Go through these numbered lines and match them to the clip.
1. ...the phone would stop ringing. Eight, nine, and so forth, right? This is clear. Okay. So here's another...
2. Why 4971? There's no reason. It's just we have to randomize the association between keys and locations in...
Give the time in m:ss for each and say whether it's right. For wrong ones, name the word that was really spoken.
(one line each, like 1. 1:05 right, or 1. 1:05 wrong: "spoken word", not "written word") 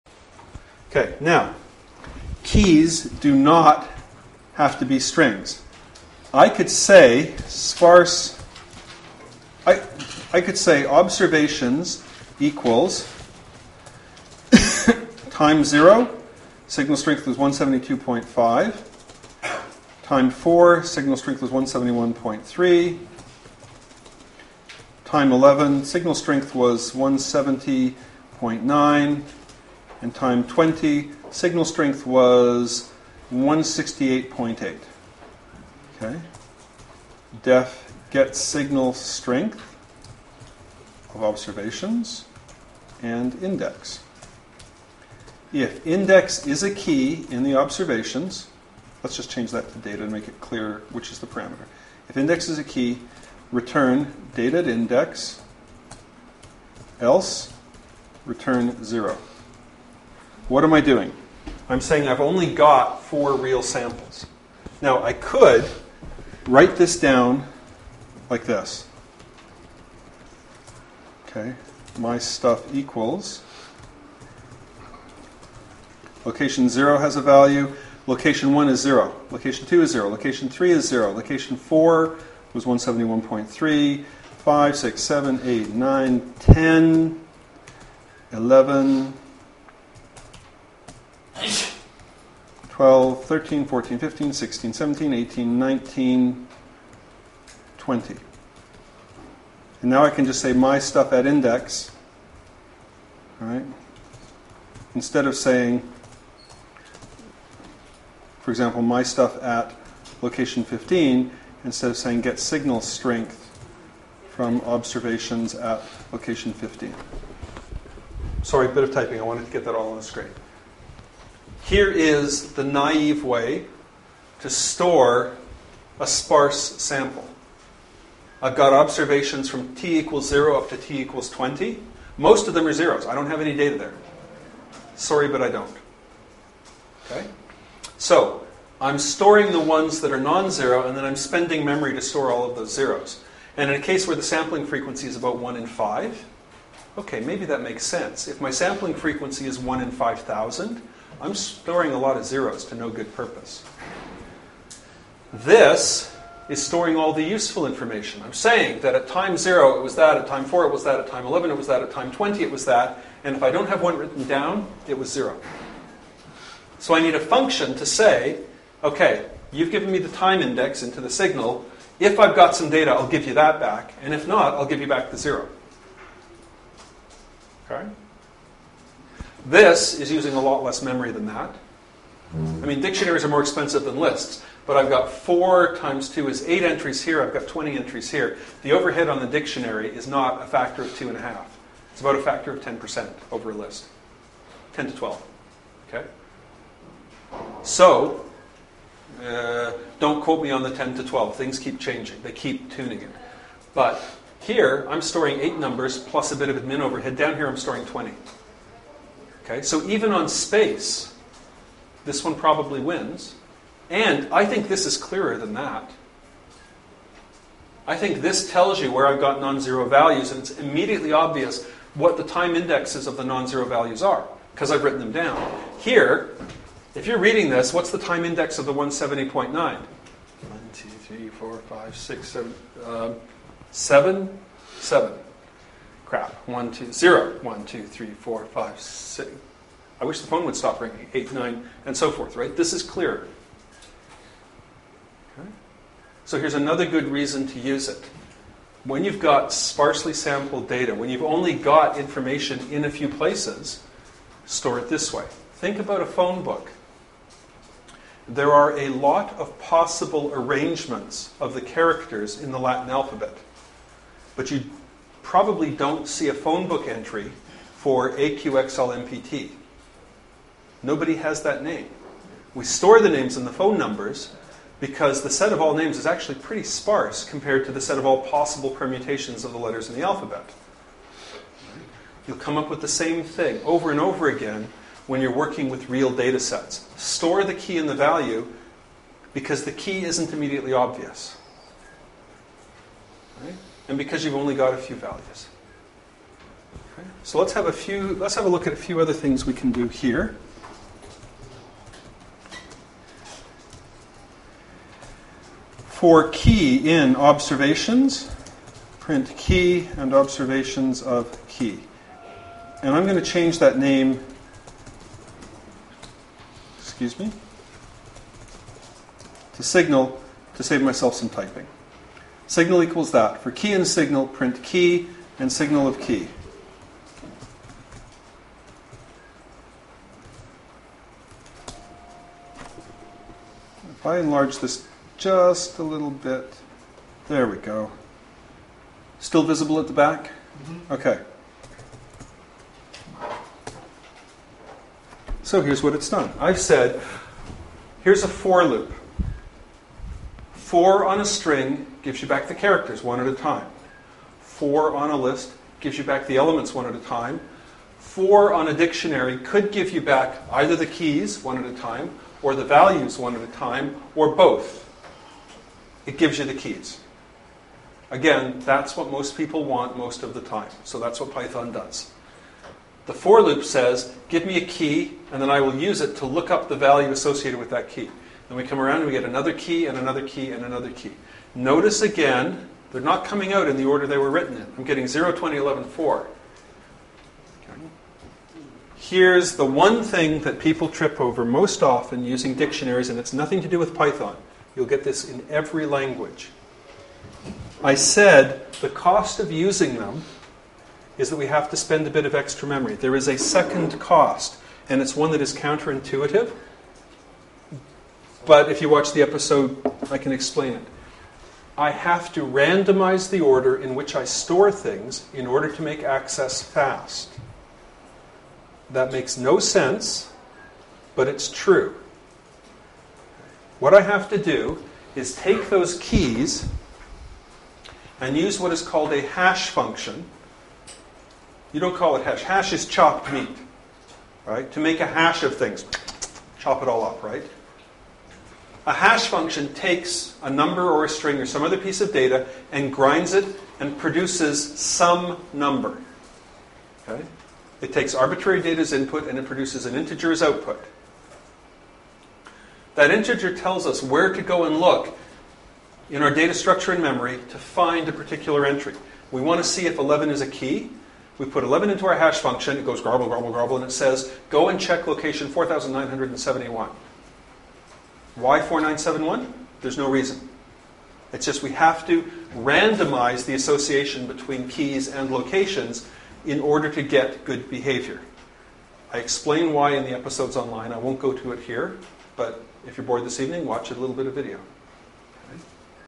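1. 4:00 right
2. 7:48 right.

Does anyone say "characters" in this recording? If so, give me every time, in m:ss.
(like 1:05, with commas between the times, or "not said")
4:21, 5:52.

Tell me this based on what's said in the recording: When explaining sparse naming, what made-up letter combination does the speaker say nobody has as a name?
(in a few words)
AQXLMPT.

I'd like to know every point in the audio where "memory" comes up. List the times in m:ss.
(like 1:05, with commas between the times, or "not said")
2:21, 3:00, 6:42, 7:37.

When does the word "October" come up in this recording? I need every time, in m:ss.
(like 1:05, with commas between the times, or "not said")
not said.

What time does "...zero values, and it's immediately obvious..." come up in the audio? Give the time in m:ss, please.
3:39.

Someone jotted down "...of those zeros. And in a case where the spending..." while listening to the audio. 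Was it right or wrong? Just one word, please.
wrong.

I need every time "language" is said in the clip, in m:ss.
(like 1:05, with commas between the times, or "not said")
6:35.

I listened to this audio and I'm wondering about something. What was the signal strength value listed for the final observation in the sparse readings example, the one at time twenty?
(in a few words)
168.8.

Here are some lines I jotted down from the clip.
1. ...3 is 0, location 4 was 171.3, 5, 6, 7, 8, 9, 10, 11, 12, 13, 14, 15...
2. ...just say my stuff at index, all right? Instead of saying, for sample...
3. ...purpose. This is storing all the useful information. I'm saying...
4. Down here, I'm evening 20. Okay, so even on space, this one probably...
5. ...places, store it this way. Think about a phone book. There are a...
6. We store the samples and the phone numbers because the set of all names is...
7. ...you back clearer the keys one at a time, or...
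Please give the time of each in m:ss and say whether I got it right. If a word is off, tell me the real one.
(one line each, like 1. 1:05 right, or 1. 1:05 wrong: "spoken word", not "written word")
1. 1:20 right
2. 1:40 wrong: "example", not "sample"
3. 2:33 right
4. 3:27 wrong: "storing", not "evening"
5. 4:13 right
6. 4:32 wrong: "names", not "samples"
7. 5:59 wrong: "either", not "clearer".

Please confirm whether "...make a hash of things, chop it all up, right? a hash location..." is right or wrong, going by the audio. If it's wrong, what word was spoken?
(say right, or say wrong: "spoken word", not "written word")
wrong: "function", not "location".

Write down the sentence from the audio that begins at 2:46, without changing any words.
So I need a function to say, okay, you've given me the time index into the signal.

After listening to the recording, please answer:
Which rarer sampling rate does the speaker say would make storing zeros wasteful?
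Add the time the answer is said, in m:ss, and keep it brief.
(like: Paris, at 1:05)
1 in 5,000, at 2:29.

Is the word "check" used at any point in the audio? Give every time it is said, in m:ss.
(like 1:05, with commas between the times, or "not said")
7:44.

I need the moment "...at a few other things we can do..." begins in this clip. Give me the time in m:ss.
4:58.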